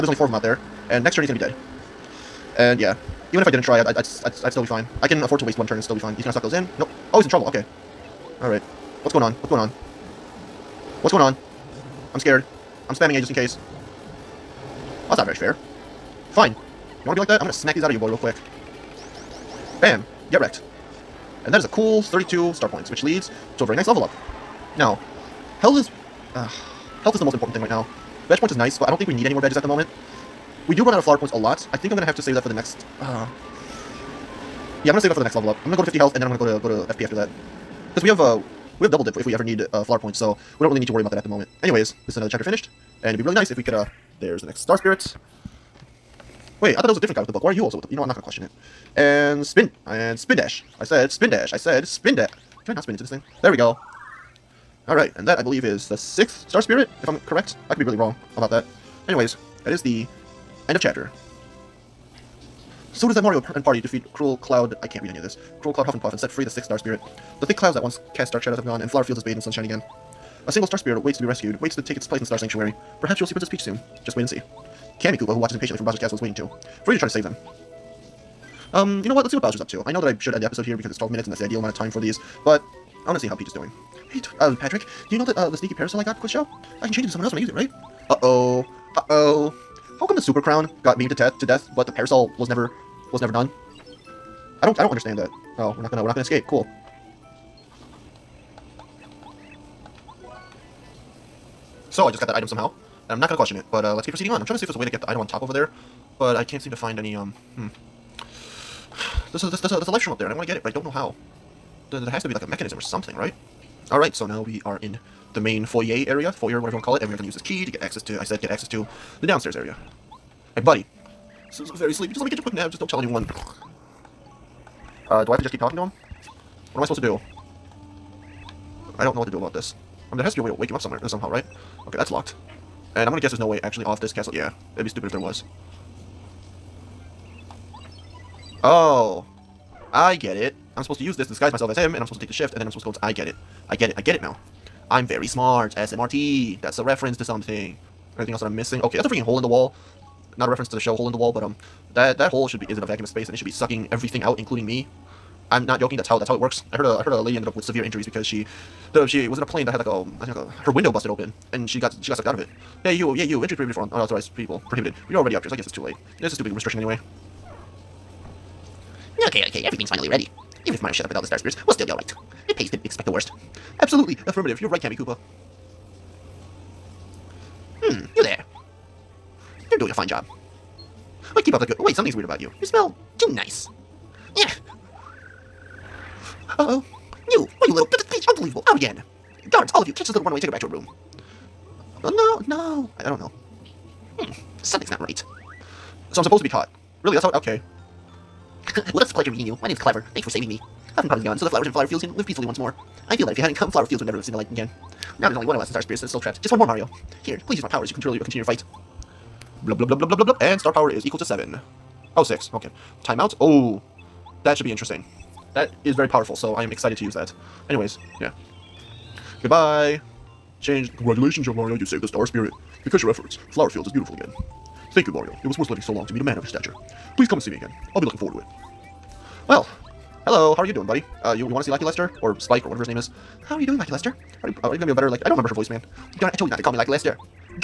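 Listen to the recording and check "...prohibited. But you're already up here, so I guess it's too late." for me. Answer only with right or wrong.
right.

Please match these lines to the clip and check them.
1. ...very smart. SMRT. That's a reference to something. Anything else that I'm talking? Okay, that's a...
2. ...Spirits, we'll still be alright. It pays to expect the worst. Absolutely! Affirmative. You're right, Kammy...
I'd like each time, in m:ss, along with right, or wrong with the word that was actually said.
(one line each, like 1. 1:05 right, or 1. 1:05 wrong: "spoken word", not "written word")
1. 2:25 wrong: "missing", not "talking"
2. 2:51 right.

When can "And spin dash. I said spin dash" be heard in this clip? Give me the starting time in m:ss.
0:49.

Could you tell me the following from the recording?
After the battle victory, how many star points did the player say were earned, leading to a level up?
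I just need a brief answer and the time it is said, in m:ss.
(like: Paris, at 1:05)
32, at 0:22.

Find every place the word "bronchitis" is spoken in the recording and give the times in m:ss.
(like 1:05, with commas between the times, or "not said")
not said.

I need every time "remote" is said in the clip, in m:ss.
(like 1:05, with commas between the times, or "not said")
not said.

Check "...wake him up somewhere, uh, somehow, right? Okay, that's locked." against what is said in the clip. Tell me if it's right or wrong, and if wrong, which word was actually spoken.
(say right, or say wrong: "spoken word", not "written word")
right.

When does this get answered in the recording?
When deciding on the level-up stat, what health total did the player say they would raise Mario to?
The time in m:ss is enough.
0:35.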